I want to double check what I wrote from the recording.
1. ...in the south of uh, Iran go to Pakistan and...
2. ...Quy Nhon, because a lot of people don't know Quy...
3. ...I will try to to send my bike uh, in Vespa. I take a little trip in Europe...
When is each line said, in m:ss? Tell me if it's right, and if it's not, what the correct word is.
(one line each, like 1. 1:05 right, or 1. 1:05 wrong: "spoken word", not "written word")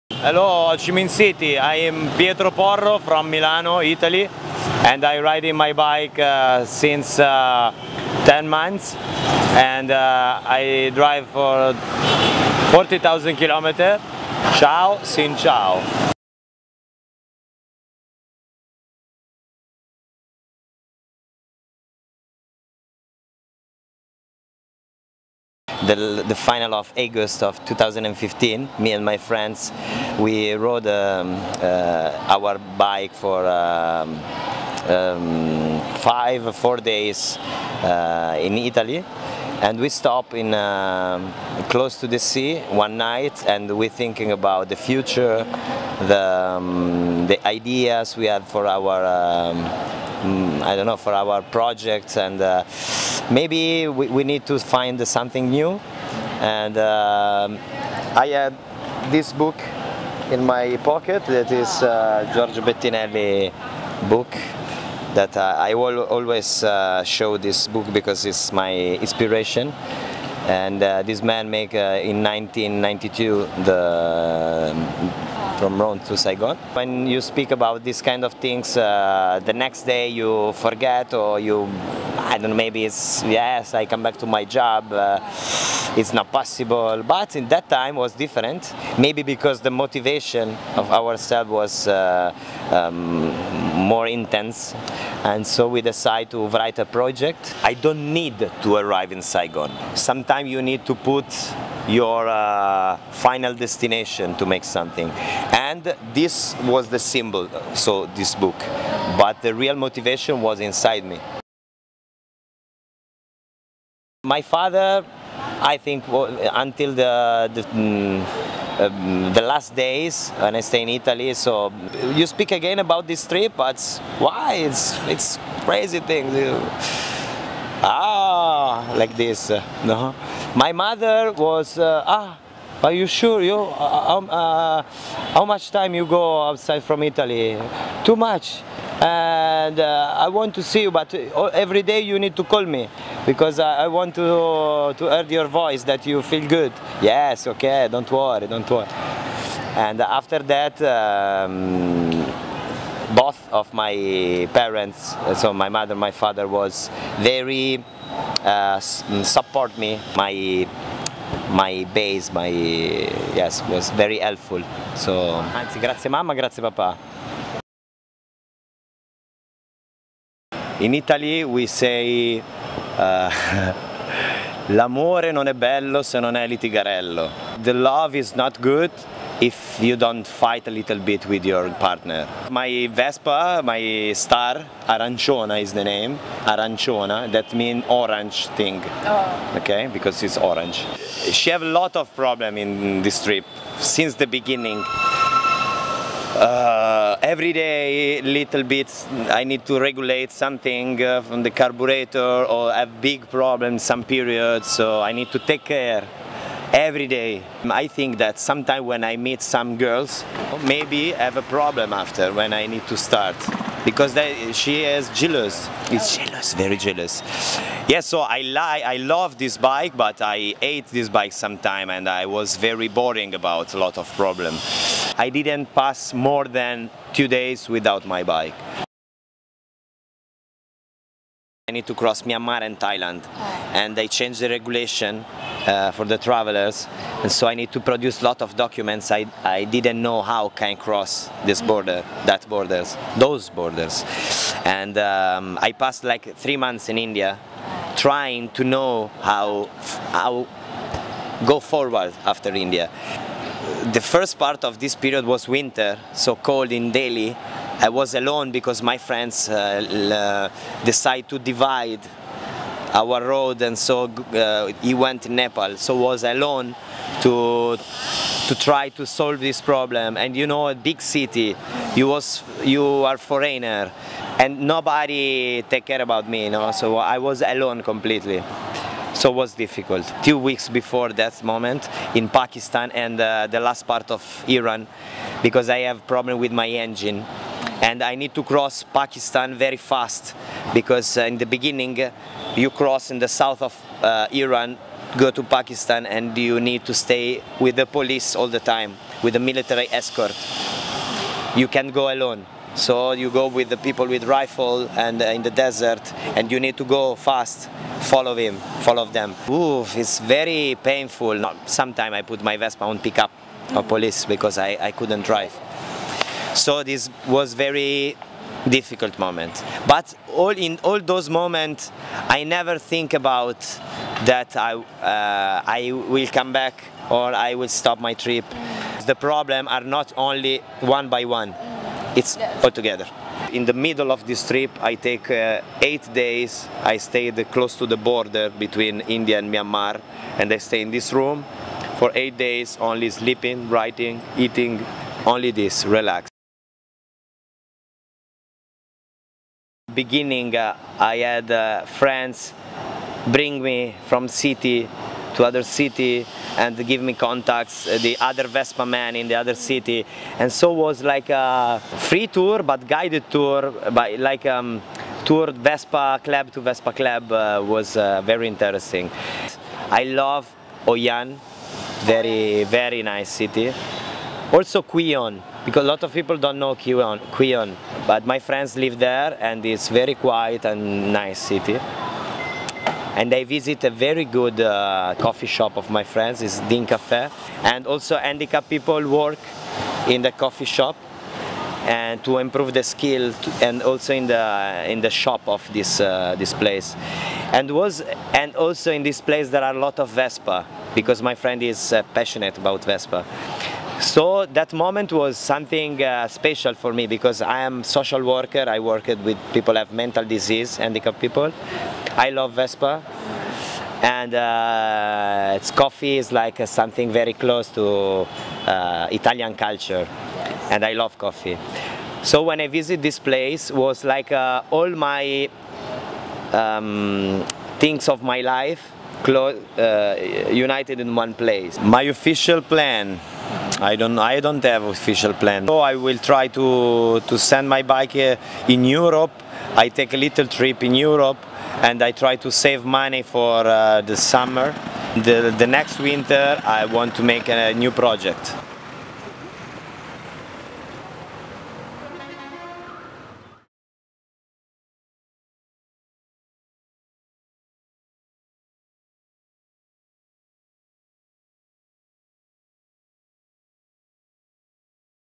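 1. 4:53 right
2. 6:14 right
3. 7:15 wrong: "Europe", not "Vespa".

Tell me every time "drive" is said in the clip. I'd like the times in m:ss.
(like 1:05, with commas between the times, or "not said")
0:10, 5:15.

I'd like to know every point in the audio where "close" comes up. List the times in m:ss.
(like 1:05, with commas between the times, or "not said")
0:41, 5:37, 6:57.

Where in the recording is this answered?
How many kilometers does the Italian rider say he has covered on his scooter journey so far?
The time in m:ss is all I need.
0:12.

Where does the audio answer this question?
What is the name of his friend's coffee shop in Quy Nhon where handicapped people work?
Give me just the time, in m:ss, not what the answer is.
6:26.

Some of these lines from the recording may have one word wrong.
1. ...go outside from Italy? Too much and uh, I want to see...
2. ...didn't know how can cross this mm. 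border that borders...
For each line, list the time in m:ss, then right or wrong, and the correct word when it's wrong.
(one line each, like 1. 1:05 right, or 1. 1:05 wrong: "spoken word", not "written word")
1. 2:16 right
2. 3:59 right.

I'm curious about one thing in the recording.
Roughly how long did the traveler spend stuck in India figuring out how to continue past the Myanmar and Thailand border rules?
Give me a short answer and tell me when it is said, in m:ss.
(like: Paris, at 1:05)
three months, at 4:06.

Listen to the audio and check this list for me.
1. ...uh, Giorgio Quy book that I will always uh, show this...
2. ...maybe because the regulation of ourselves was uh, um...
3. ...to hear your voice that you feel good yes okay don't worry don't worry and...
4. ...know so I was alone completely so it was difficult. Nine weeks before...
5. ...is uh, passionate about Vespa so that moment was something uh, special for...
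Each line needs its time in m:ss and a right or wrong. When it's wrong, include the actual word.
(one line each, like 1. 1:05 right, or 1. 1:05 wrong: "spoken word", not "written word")
1. 1:01 wrong: "Bettinelli", not "Quy"
2. 1:28 wrong: "motivation", not "regulation"
3. 2:24 right
4. 4:36 wrong: "Two", not "Nine"
5. 6:41 right.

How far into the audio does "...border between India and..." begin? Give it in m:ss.
5:37.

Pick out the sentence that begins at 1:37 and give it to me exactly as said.
I don't need to arrive in Saigon.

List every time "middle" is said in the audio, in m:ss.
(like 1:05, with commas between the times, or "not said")
5:33.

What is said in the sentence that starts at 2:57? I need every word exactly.
The love is not good if you don't fight a little bit with your partner.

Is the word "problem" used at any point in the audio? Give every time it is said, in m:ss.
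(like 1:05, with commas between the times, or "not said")
3:12, 3:23, 3:31, 3:44, 4:29, 4:46, 5:29.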